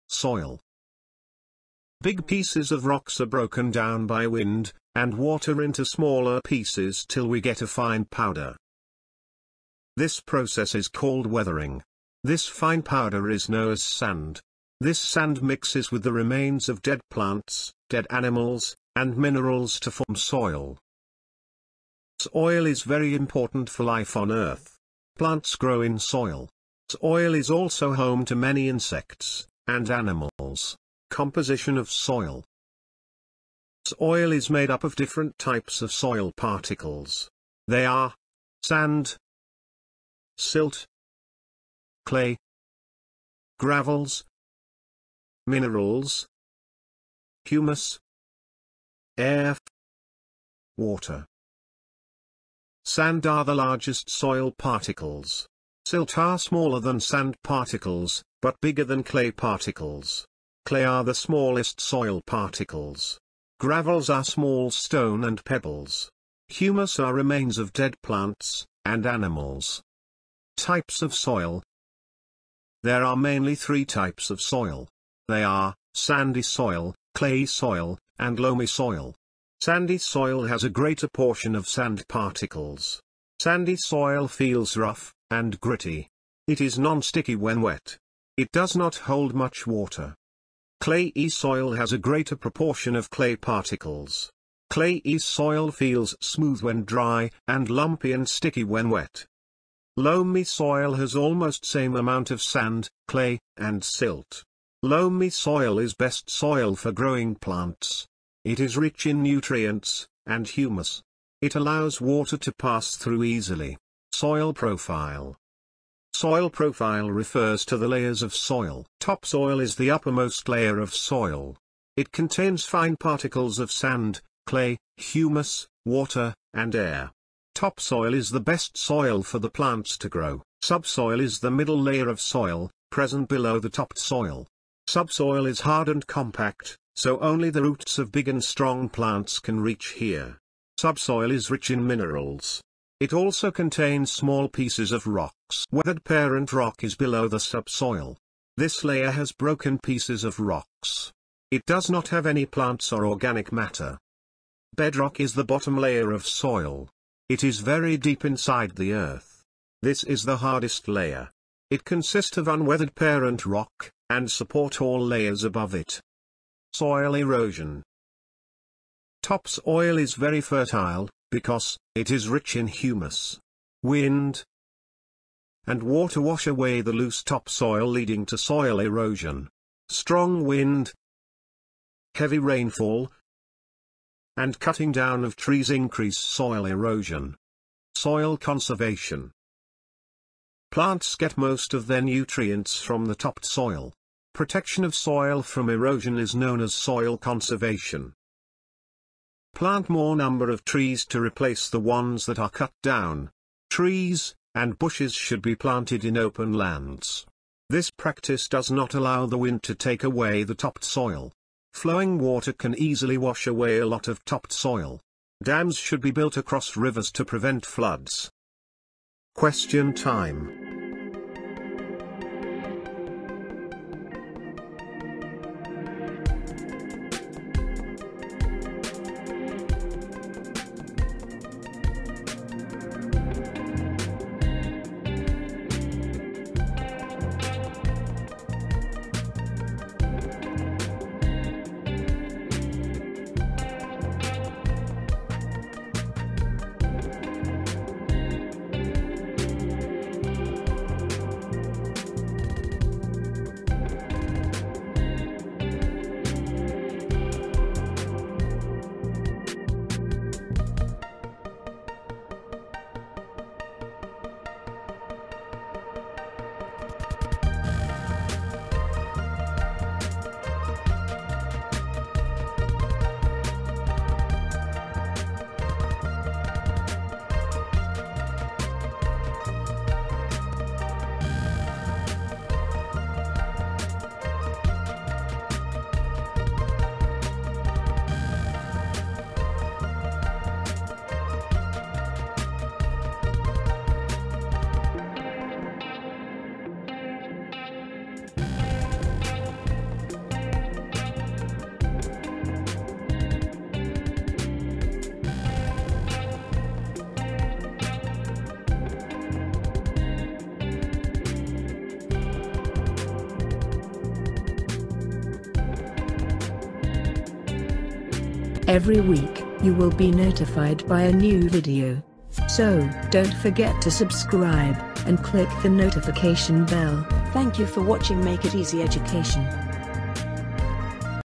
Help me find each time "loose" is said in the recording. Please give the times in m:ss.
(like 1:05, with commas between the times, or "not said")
2:56.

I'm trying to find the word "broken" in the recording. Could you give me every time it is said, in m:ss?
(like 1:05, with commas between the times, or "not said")
0:03, 2:29.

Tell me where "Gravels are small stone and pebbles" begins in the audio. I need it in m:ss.
1:03.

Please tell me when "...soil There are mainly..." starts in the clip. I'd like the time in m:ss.
1:11.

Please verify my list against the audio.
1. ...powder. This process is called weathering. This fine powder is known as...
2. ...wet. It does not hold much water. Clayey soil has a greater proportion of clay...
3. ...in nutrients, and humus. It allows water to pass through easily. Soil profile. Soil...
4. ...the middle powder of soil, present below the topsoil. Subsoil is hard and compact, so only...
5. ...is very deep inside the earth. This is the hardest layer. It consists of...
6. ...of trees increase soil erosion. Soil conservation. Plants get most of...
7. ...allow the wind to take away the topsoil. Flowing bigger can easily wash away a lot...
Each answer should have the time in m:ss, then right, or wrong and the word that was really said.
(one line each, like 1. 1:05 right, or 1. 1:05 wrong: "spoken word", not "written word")
1. 0:08 right
2. 1:27 right
3. 1:49 right
4. 2:11 wrong: "layer", not "powder"
5. 2:37 right
6. 3:05 right
7. 3:28 wrong: "water", not "bigger".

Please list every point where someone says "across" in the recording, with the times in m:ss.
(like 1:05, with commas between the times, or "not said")
3:36.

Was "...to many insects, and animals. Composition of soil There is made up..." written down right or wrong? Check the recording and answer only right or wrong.
wrong.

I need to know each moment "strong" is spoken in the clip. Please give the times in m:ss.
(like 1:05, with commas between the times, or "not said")
2:18, 2:59.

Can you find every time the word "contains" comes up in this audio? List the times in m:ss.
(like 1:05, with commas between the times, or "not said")
2:02, 2:23.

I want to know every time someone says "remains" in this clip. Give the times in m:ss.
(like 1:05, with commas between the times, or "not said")
0:16, 1:07.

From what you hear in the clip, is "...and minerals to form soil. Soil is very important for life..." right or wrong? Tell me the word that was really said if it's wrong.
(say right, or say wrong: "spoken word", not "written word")
right.